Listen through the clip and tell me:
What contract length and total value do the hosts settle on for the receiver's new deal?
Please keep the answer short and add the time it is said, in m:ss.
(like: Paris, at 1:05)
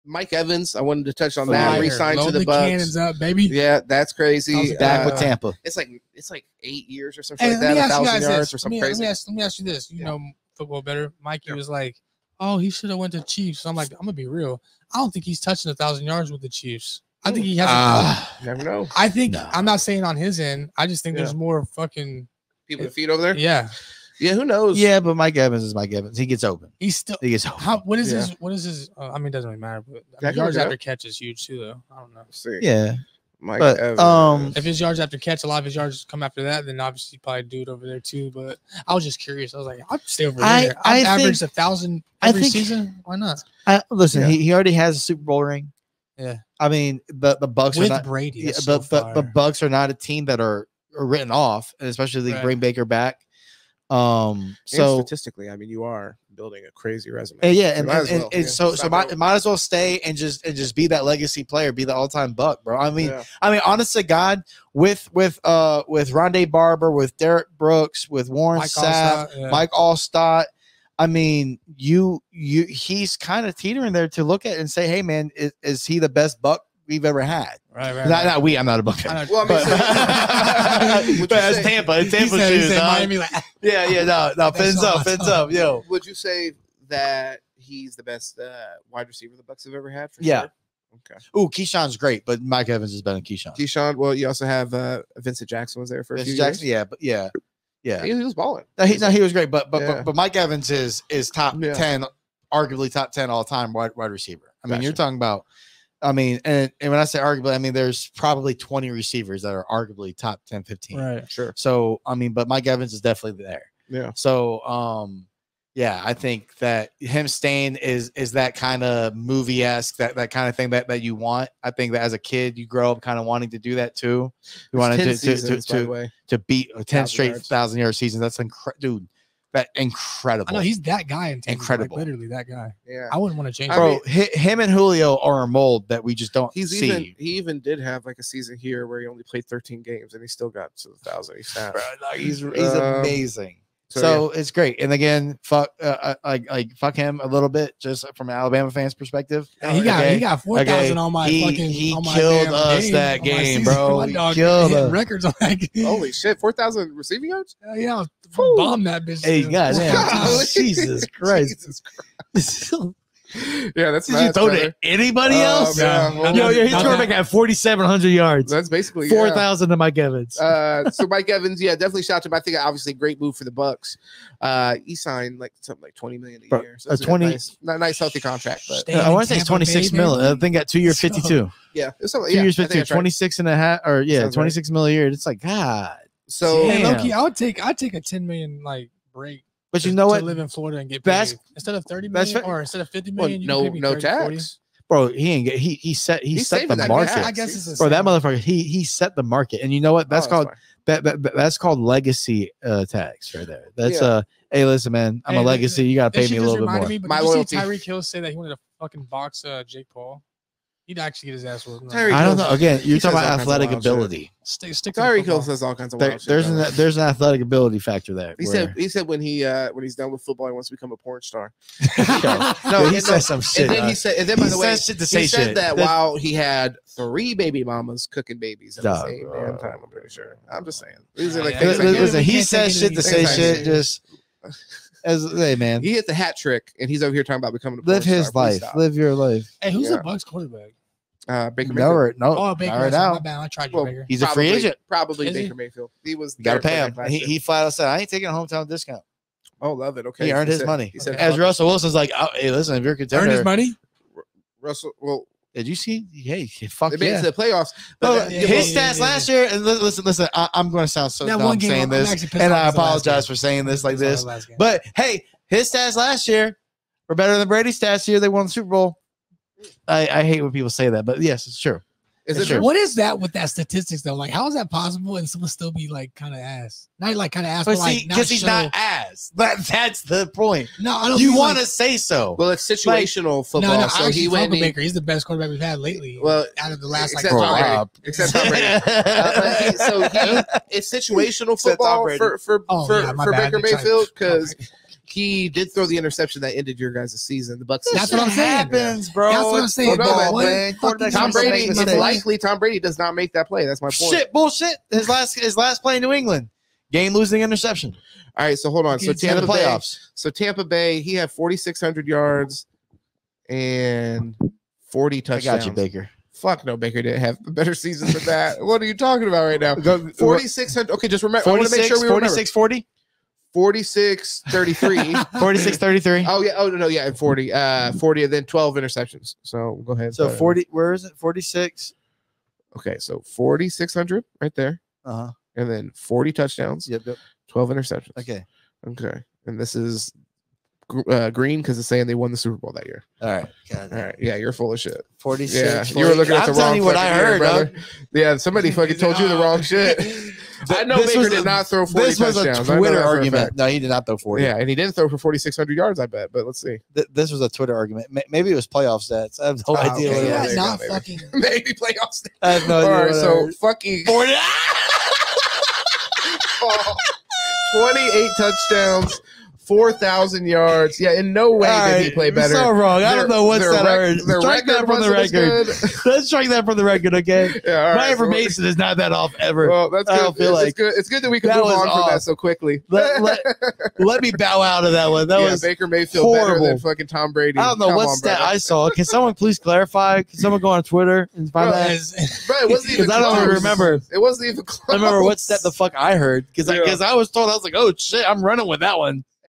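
two year 52, at 3:02.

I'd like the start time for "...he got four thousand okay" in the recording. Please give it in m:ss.
2:30.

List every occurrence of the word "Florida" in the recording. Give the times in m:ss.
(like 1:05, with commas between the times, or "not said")
3:10.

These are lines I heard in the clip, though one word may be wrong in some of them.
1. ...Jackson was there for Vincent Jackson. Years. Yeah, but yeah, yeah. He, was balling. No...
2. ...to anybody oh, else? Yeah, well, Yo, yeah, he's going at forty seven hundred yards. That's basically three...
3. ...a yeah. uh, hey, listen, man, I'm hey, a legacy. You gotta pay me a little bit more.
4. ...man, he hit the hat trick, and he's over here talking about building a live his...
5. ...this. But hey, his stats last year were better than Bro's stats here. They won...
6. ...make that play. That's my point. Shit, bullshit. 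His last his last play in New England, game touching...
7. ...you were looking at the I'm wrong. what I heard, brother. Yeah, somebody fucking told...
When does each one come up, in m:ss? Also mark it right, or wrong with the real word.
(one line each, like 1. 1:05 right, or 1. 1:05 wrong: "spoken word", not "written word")
1. 1:35 right
2. 2:44 wrong: "four", not "three"
3. 3:24 right
4. 3:55 wrong: "becoming", not "building"
5. 4:23 wrong: "Brady", not "Bro"
6. 5:03 wrong: "losing", not "touching"
7. 5:45 right.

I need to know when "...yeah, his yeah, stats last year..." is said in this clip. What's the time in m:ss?
4:18.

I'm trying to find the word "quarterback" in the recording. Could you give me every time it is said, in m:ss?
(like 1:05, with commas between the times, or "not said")
4:00, 4:45.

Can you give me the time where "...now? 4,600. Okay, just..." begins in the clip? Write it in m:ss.
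5:19.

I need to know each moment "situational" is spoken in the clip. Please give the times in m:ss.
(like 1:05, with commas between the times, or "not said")
4:42, 4:50.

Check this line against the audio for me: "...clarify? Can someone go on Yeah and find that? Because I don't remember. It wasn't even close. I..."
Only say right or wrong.
wrong.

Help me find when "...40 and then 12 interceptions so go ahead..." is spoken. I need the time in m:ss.
5:27.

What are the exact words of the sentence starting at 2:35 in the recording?
Holy shit, four thousand receiving yards?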